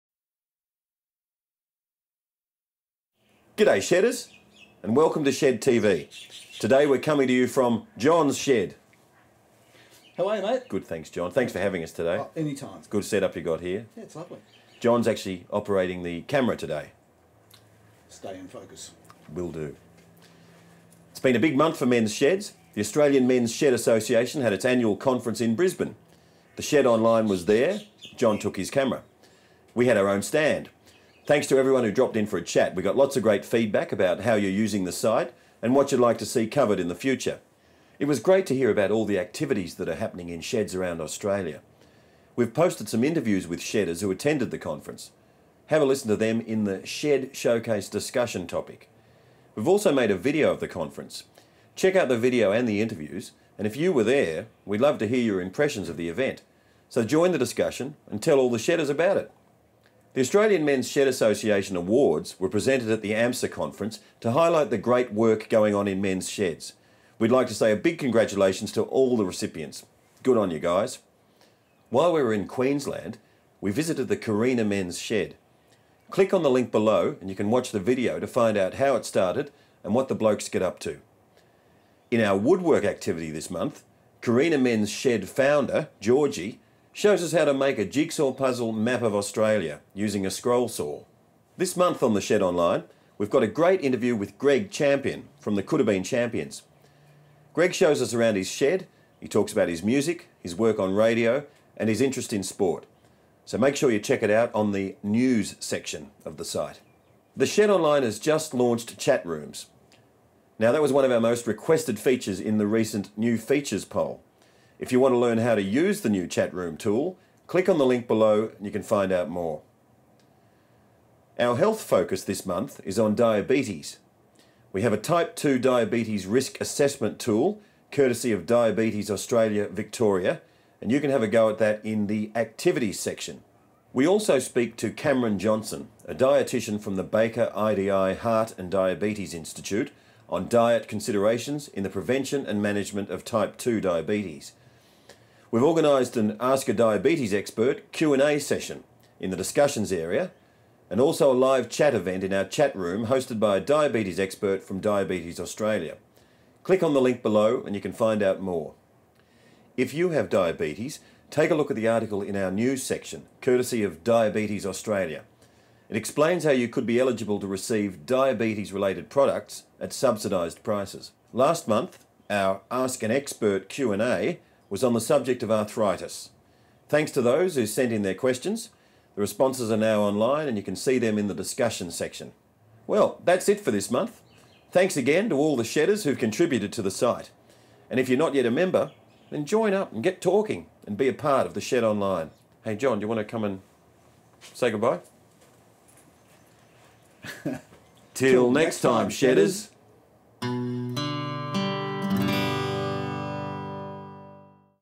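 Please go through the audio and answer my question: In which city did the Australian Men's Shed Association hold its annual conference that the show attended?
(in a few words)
Brisbane.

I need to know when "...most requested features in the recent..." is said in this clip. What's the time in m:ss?
1:51.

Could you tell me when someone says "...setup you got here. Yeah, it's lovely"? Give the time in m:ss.
0:13.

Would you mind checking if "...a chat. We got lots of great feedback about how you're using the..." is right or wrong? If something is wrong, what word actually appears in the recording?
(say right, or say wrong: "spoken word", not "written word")
right.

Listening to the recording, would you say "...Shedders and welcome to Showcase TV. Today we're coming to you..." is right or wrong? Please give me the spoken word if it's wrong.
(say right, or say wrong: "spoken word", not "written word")
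wrong: "Shed", not "Showcase".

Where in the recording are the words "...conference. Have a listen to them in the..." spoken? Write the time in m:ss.
0:44.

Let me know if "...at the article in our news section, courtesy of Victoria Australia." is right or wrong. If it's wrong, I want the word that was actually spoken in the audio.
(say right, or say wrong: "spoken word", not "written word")
wrong: "Diabetes", not "Victoria".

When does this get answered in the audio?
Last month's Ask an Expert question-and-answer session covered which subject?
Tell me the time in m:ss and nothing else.
2:55.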